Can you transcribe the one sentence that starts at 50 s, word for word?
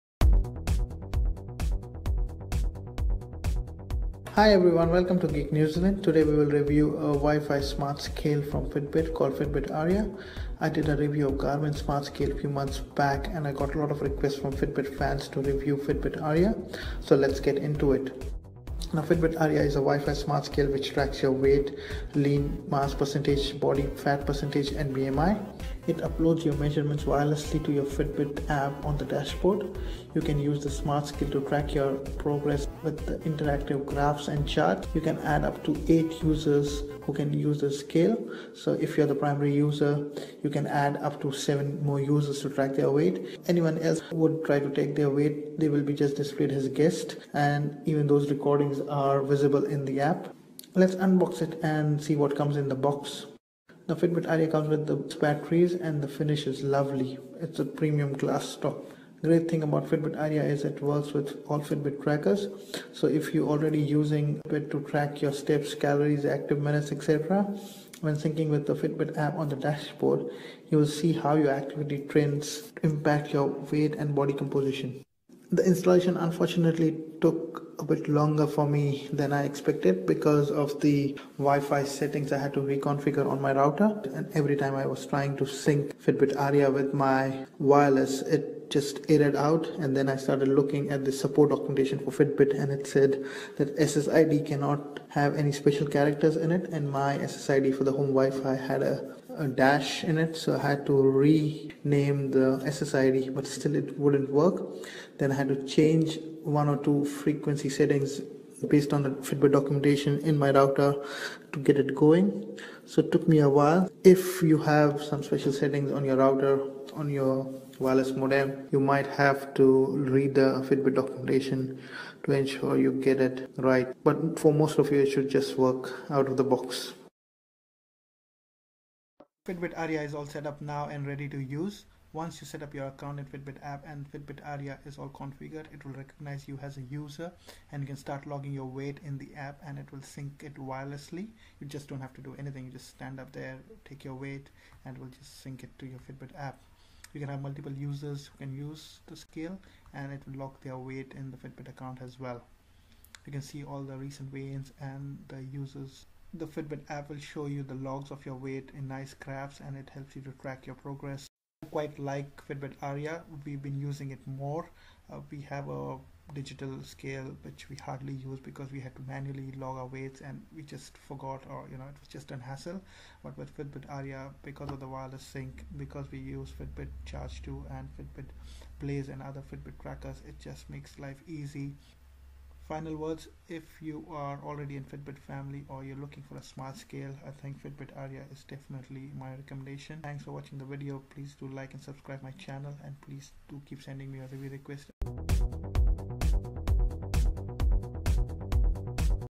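Let's unbox it and see what comes in the box.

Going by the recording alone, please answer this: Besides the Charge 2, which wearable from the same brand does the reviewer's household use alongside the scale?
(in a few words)
Fitbit Blaze.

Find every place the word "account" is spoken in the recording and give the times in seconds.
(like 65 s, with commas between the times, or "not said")
132 s, 151 s.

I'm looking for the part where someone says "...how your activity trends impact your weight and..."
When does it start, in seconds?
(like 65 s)
71 s.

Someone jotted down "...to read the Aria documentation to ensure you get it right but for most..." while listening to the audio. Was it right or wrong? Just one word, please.
wrong.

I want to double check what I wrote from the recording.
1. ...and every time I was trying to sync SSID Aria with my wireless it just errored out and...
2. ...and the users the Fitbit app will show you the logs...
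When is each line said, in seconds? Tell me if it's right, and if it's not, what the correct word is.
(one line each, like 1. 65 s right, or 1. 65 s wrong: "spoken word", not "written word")
1. 84 s wrong: "Fitbit", not "SSID"
2. 154 s right.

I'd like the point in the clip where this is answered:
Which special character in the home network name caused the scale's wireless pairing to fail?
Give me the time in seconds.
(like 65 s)
99 s.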